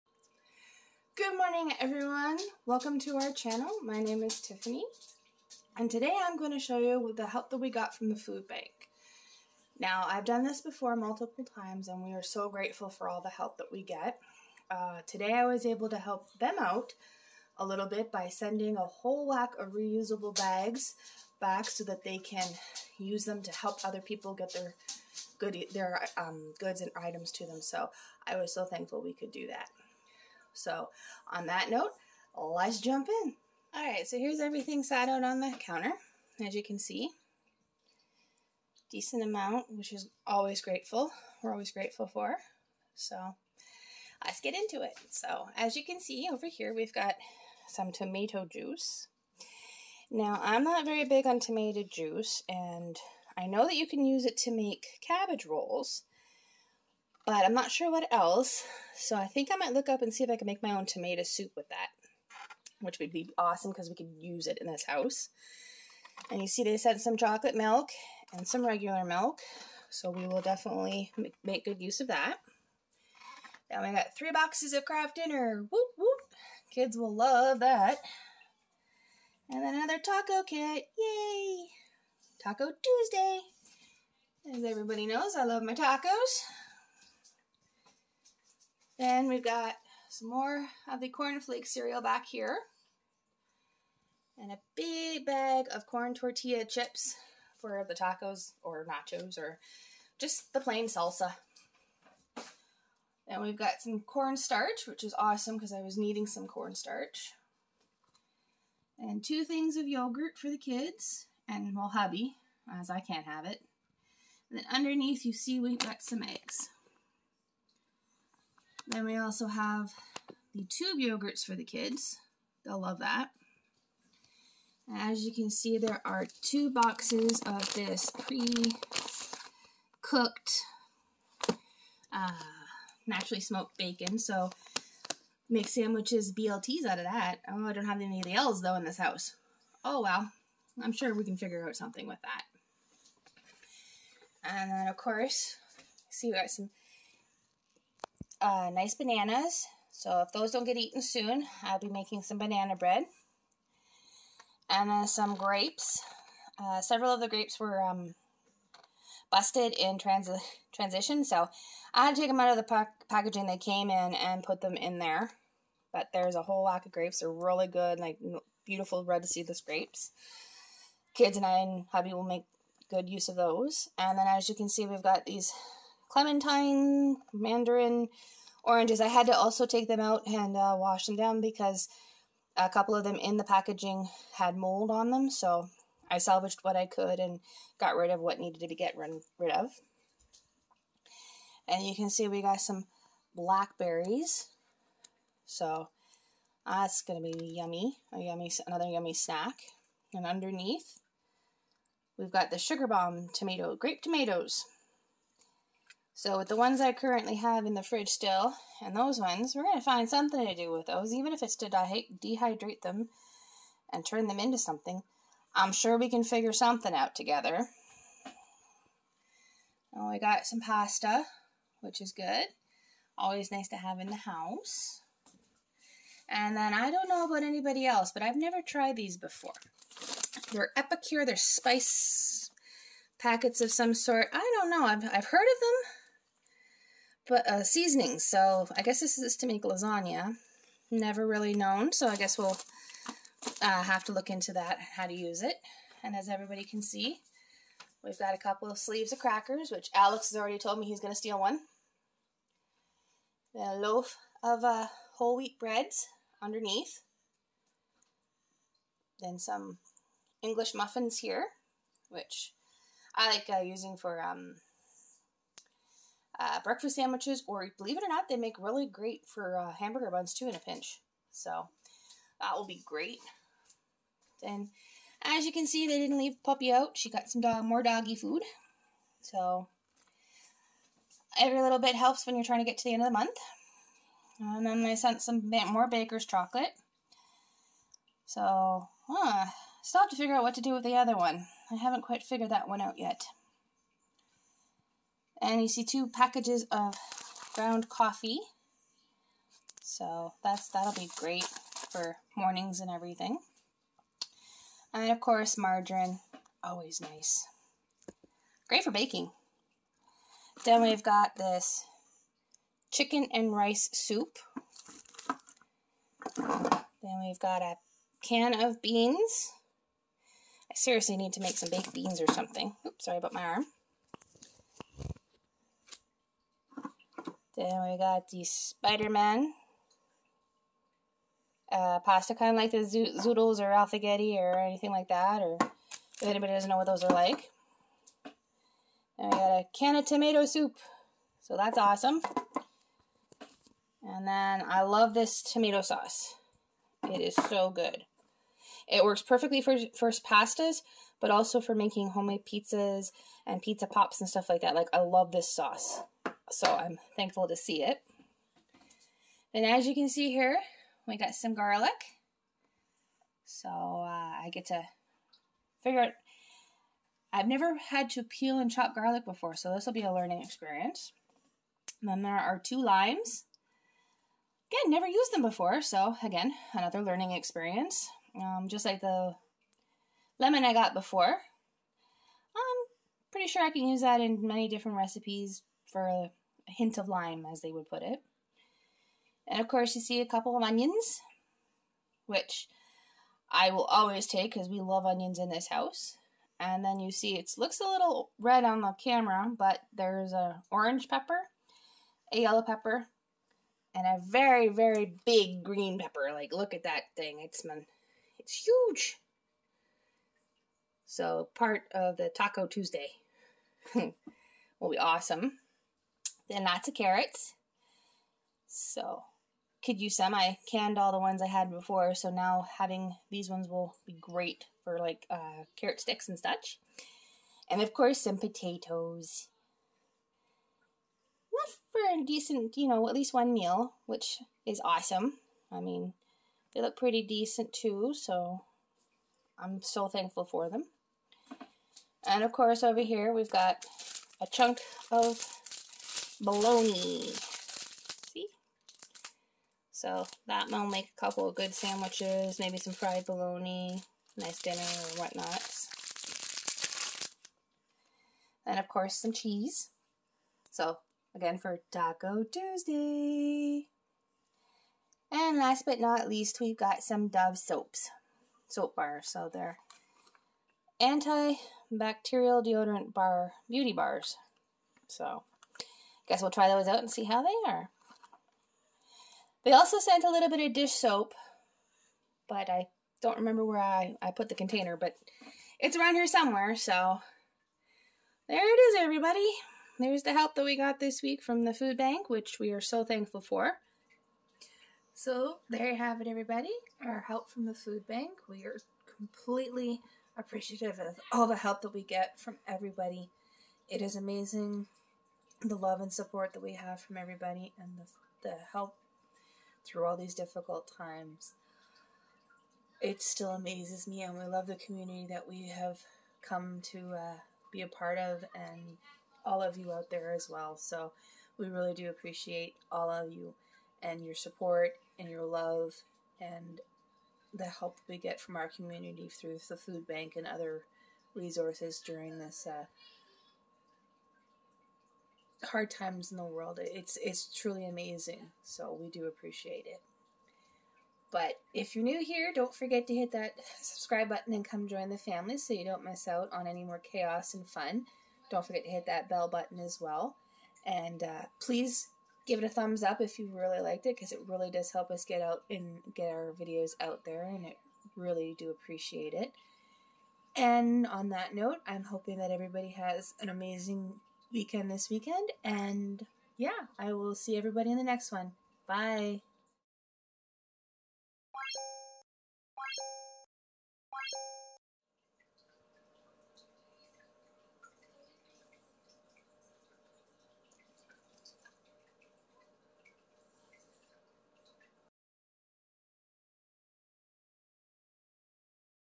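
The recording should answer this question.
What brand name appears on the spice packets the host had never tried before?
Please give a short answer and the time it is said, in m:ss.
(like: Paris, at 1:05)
Epicure, at 3:50.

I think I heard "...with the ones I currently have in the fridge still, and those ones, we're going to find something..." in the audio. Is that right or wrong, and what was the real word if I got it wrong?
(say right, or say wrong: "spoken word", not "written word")
right.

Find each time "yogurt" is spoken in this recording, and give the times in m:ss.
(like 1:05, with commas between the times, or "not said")
1:49, 2:00.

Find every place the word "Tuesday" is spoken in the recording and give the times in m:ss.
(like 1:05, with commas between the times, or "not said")
1:22, 6:52, 7:42.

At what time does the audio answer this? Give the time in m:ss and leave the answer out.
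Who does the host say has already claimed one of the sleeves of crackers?
4:09.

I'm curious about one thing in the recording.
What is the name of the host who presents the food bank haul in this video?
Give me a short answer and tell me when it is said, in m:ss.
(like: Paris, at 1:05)
Tiffany, at 0:04.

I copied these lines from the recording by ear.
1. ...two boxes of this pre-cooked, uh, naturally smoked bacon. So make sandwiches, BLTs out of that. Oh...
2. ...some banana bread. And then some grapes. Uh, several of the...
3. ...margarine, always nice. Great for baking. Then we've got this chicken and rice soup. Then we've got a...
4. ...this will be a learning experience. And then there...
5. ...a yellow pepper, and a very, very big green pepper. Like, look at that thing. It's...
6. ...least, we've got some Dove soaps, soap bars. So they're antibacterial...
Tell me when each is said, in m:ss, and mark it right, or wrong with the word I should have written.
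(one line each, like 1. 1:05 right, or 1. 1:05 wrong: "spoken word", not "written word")
1. 2:06 right
2. 2:32 right
3. 5:05 right
4. 6:09 right
5. 6:42 right
6. 7:46 right.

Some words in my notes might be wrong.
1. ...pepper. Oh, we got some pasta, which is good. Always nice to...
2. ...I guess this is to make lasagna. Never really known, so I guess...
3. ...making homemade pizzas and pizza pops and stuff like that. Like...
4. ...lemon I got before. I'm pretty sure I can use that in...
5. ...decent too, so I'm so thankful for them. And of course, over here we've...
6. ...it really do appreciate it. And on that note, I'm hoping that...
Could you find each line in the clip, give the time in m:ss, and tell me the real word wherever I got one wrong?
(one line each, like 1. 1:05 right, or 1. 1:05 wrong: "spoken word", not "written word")
1. 3:37 wrong: "together", not "pepper"
2. 3:58 right
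3. 5:51 right
4. 6:20 right
5. 7:17 right
6. 9:17 right.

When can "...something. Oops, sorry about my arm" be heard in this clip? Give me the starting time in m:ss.
5:22.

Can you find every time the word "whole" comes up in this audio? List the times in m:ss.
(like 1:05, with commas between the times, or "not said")
0:18, 2:46, 4:15.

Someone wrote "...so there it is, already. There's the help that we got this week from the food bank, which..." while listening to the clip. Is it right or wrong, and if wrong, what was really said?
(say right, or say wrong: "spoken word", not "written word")
wrong: "everybody", not "already".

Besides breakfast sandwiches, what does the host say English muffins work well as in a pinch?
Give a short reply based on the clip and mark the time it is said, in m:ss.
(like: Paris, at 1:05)
Hamburger buns, at 4:29.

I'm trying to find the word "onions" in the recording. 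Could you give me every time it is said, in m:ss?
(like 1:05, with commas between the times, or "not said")
6:30, 6:35.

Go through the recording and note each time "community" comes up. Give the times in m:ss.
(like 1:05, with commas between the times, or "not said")
8:34, 8:48.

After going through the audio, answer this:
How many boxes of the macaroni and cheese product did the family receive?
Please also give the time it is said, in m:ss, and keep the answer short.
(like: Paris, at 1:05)
3, at 1:14.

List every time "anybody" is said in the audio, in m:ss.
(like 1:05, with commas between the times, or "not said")
3:47, 5:36.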